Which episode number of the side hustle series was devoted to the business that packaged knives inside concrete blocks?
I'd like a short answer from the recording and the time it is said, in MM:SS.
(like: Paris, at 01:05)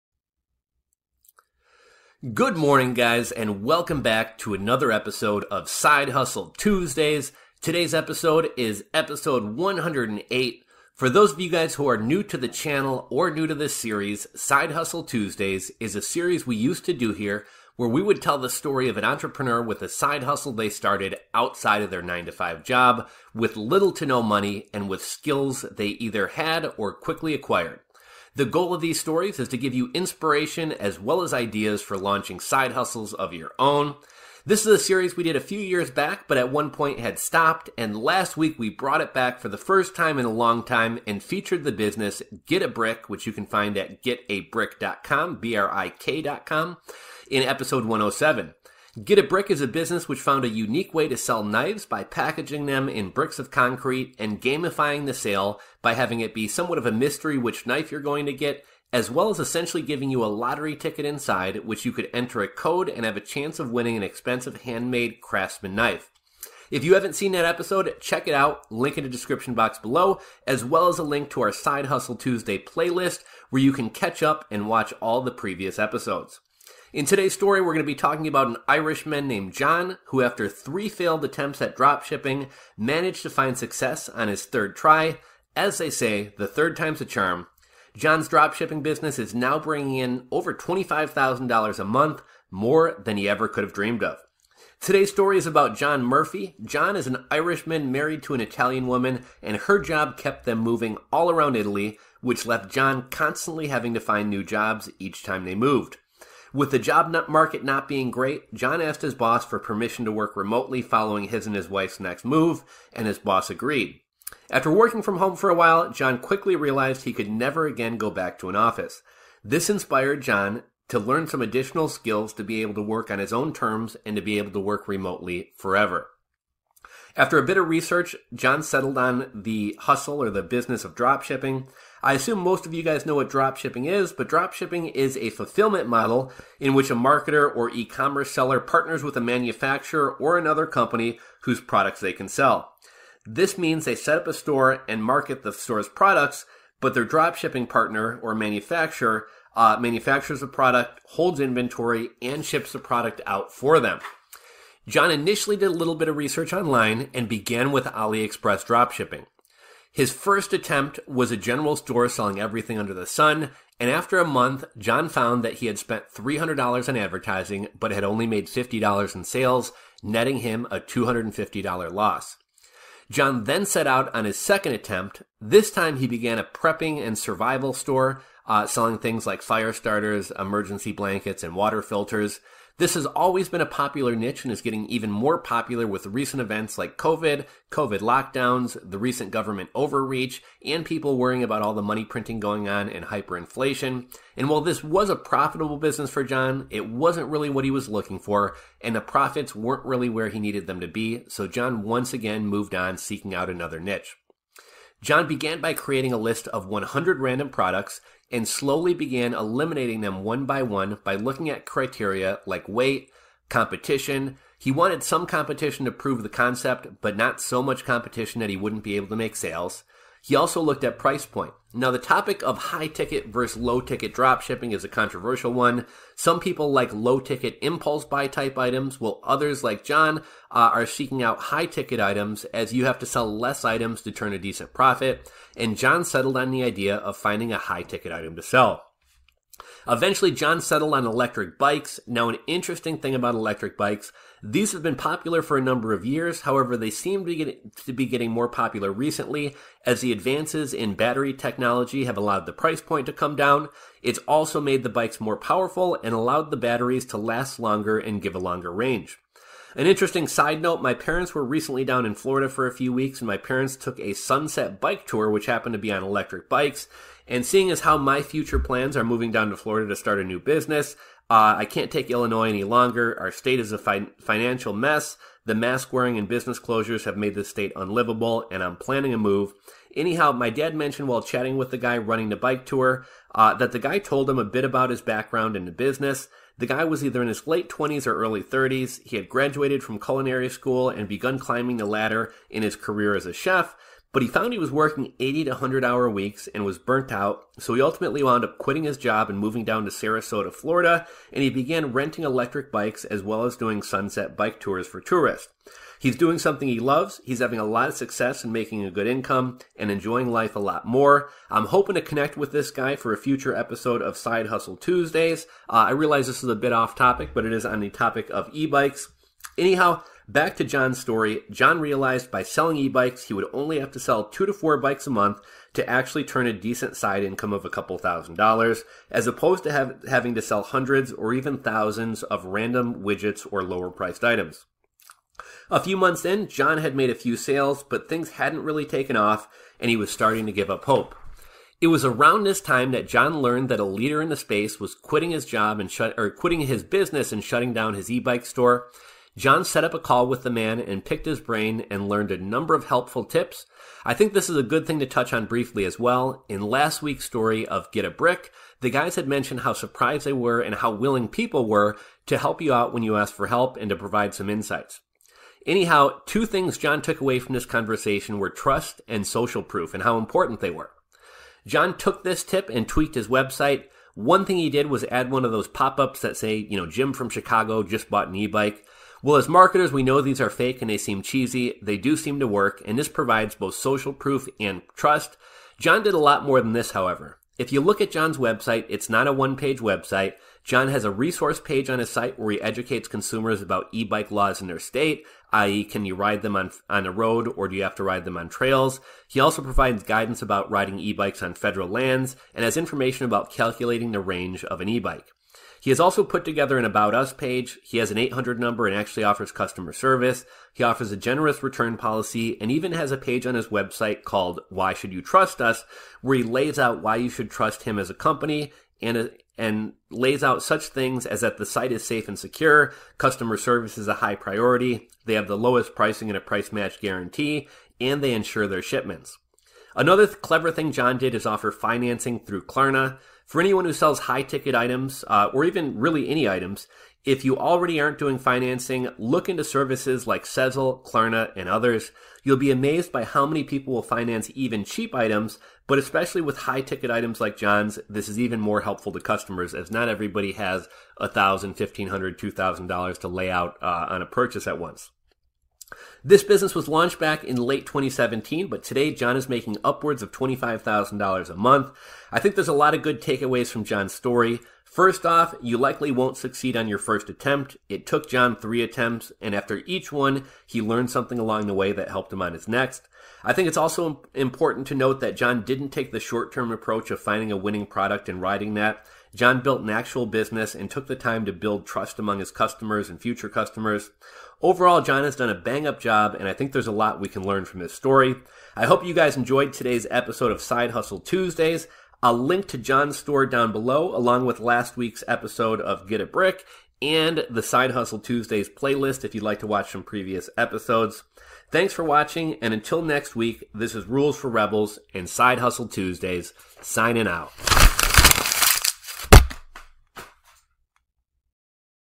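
107, at 00:47.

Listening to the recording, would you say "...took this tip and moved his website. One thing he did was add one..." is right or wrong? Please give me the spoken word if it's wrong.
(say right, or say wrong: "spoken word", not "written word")
wrong: "tweaked", not "moved".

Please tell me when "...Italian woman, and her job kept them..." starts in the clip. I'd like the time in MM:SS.
01:38.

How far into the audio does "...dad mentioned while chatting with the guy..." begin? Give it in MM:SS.
04:40.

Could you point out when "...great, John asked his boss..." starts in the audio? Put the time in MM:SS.
01:48.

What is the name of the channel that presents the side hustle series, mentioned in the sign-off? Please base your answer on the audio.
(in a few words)
Rules for Rebels.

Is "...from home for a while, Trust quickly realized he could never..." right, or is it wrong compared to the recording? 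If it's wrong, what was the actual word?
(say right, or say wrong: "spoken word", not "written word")
wrong: "John", not "Trust".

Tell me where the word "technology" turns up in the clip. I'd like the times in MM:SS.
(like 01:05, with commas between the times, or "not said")
04:11.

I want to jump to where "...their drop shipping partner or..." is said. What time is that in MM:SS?
02:26.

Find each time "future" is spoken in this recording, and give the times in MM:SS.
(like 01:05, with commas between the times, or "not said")
04:28, 05:13, 08:03.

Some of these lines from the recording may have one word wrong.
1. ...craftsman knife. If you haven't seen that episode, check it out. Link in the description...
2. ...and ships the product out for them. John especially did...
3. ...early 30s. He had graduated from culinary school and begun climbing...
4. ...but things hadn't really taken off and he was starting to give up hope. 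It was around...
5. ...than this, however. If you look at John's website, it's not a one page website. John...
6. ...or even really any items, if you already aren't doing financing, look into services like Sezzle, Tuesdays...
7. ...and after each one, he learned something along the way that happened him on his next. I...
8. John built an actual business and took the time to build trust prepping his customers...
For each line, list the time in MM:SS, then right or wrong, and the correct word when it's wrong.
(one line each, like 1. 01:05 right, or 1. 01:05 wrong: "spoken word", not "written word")
1. 01:05 right
2. 02:32 wrong: "initially", not "especially"
3. 04:48 right
4. 05:37 right
5. 06:26 right
6. 07:15 wrong: "Klarna", not "Tuesdays"
7. 07:49 wrong: "helped", not "happened"
8. 07:59 wrong: "among", not "prepping".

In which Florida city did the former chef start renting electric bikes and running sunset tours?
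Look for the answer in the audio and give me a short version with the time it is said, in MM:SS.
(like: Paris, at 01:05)
Sarasota, at 04:59.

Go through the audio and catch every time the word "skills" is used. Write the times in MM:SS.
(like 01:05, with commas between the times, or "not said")
00:25, 02:01.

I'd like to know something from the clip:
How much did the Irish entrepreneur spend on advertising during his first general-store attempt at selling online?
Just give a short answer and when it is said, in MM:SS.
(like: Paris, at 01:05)
$300, at 02:46.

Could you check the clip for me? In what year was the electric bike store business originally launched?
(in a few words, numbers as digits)
2017.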